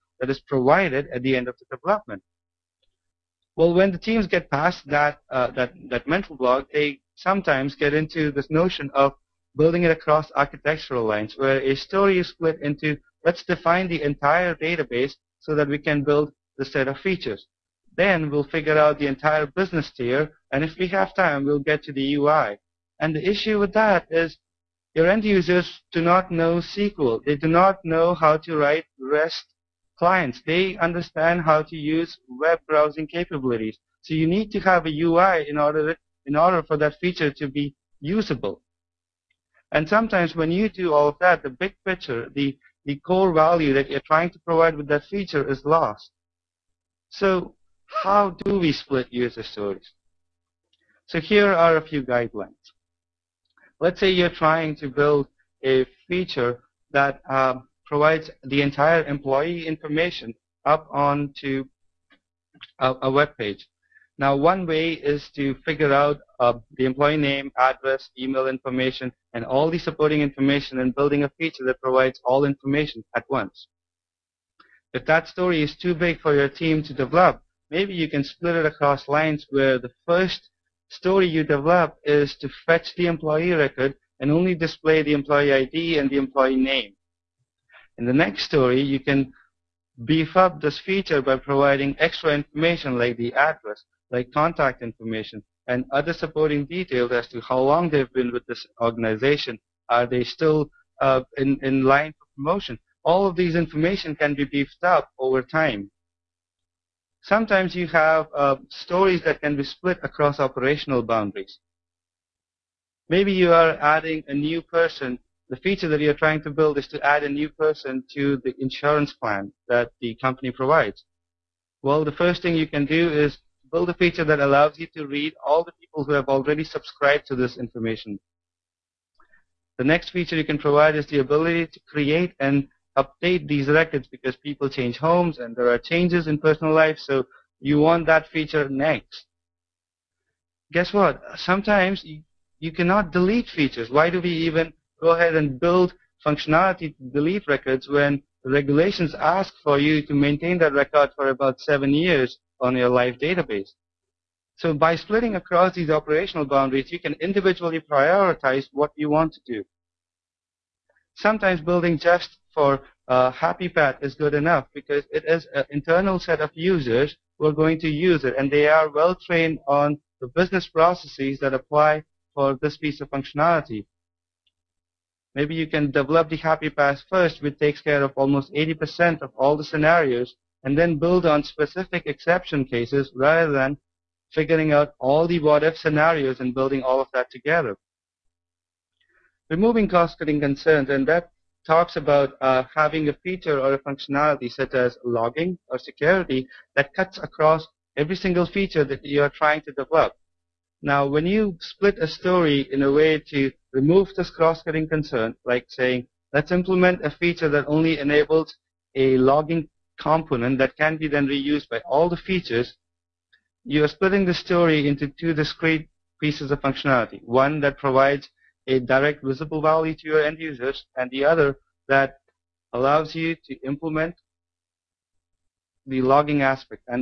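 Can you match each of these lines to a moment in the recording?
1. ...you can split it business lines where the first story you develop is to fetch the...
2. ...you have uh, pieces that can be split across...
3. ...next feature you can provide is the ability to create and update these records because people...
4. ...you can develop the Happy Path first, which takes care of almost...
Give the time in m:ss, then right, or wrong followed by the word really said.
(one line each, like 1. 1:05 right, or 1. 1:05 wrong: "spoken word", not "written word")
1. 1:17 wrong: "across", not "business"
2. 1:47 wrong: "stories", not "pieces"
3. 2:09 right
4. 2:55 right.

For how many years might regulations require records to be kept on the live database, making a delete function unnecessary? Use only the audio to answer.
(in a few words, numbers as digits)
7.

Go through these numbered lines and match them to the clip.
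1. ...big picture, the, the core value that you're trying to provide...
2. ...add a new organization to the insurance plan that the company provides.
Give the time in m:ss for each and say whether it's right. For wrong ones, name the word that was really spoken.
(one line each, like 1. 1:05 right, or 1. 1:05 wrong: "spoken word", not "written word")
1. 0:41 right
2. 1:57 wrong: "person", not "organization".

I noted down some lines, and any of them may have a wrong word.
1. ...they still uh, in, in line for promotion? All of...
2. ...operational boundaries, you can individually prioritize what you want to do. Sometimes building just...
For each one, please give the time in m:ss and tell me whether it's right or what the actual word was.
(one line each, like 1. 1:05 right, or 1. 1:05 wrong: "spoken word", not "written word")
1. 1:40 right
2. 2:35 right.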